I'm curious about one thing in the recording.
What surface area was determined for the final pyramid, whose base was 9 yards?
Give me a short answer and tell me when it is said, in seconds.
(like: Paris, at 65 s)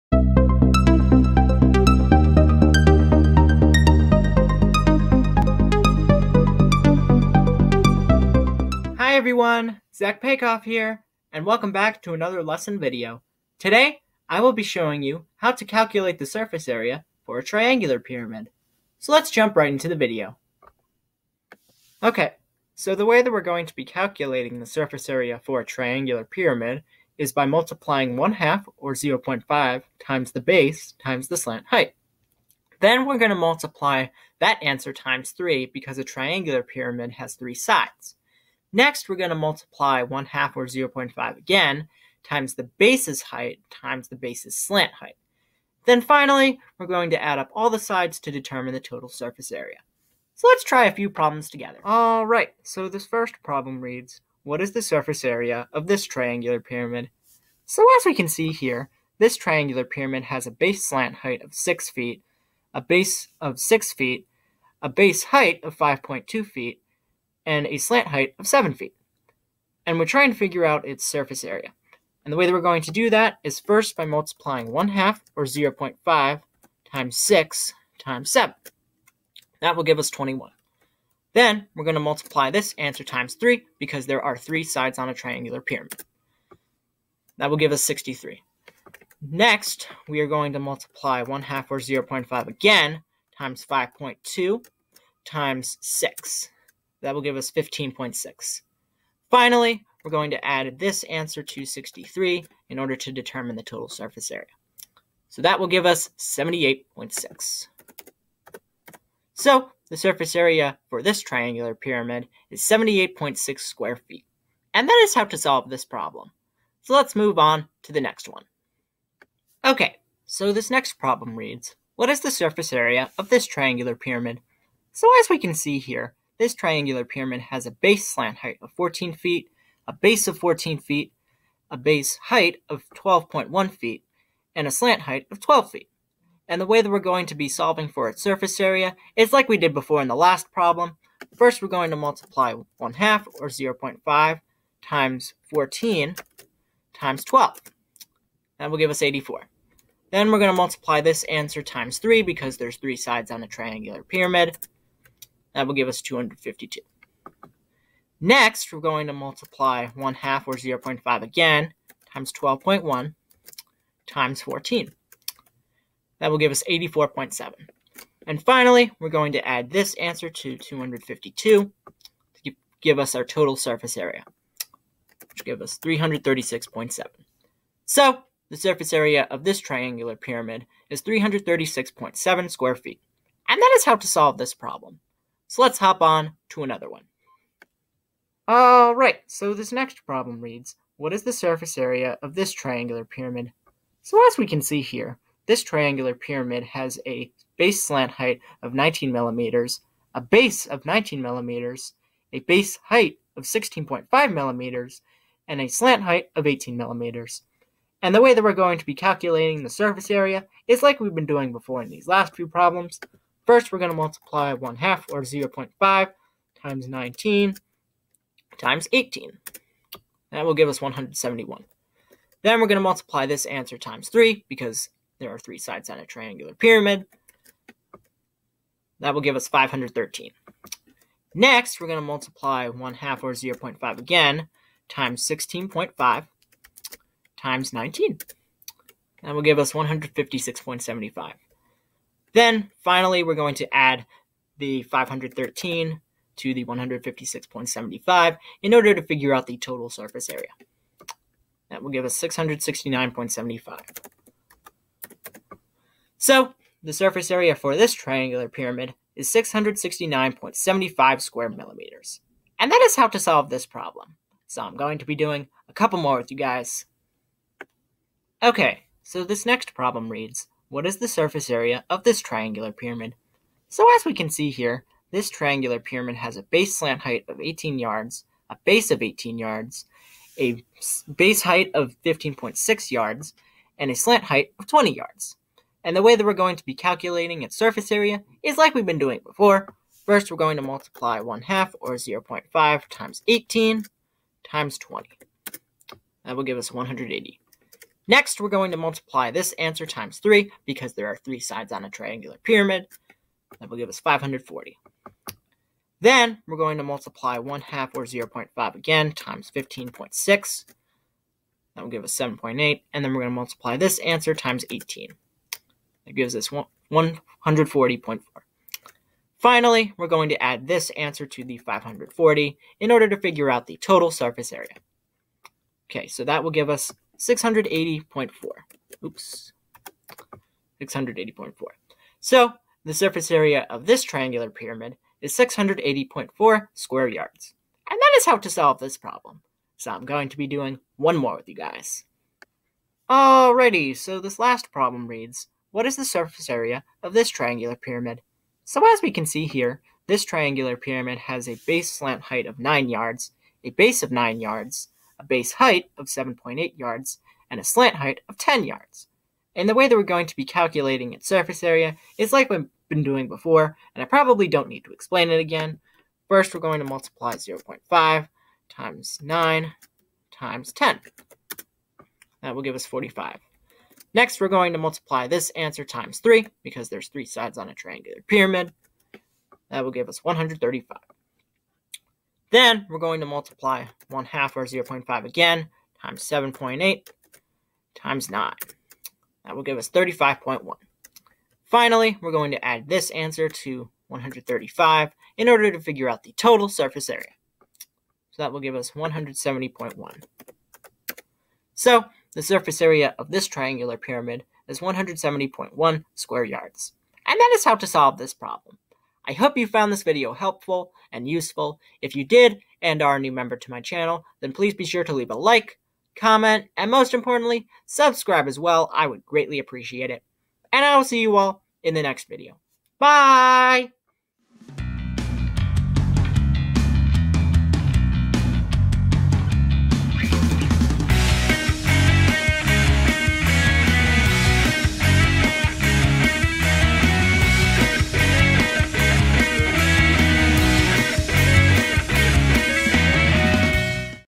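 170.1 square yards, at 404 s.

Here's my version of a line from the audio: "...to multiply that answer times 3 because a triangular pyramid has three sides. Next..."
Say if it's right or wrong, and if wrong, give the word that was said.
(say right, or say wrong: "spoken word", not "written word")
right.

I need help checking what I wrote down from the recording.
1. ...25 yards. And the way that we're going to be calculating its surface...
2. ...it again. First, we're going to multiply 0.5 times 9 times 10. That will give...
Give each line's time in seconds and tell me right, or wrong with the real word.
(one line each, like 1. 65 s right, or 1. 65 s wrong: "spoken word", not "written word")
1. 284 s wrong: "20", not "25"
2. 365 s right.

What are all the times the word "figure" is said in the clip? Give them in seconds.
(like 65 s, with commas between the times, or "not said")
70 s, 249 s, 323 s, 395 s.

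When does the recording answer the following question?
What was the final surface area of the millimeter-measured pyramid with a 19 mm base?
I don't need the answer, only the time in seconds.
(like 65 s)
259 s.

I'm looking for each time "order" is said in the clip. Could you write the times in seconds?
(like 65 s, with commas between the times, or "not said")
102 s, 248 s, 322 s, 395 s.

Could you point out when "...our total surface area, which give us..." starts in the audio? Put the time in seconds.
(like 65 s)
173 s.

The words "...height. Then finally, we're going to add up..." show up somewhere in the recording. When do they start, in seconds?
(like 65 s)
44 s.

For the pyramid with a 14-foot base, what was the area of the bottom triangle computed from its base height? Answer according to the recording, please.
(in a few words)
84.7.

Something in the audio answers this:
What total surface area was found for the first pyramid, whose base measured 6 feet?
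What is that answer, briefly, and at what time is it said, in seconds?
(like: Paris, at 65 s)
78.6 square feet, at 112 s.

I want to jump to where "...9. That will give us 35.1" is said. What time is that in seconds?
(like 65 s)
388 s.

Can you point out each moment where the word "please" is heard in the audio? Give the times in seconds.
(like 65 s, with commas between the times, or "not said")
414 s.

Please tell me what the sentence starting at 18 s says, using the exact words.
So let's jump right into the video.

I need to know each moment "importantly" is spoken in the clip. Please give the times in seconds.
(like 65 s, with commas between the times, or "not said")
417 s.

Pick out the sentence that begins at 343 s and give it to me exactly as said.
Alrighty, so this last problem reads, what is the surface area of this triangular pyramid?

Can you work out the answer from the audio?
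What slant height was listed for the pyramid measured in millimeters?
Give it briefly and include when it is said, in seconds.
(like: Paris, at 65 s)
18 millimeters, at 205 s.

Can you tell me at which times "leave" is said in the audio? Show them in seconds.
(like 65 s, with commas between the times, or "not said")
415 s.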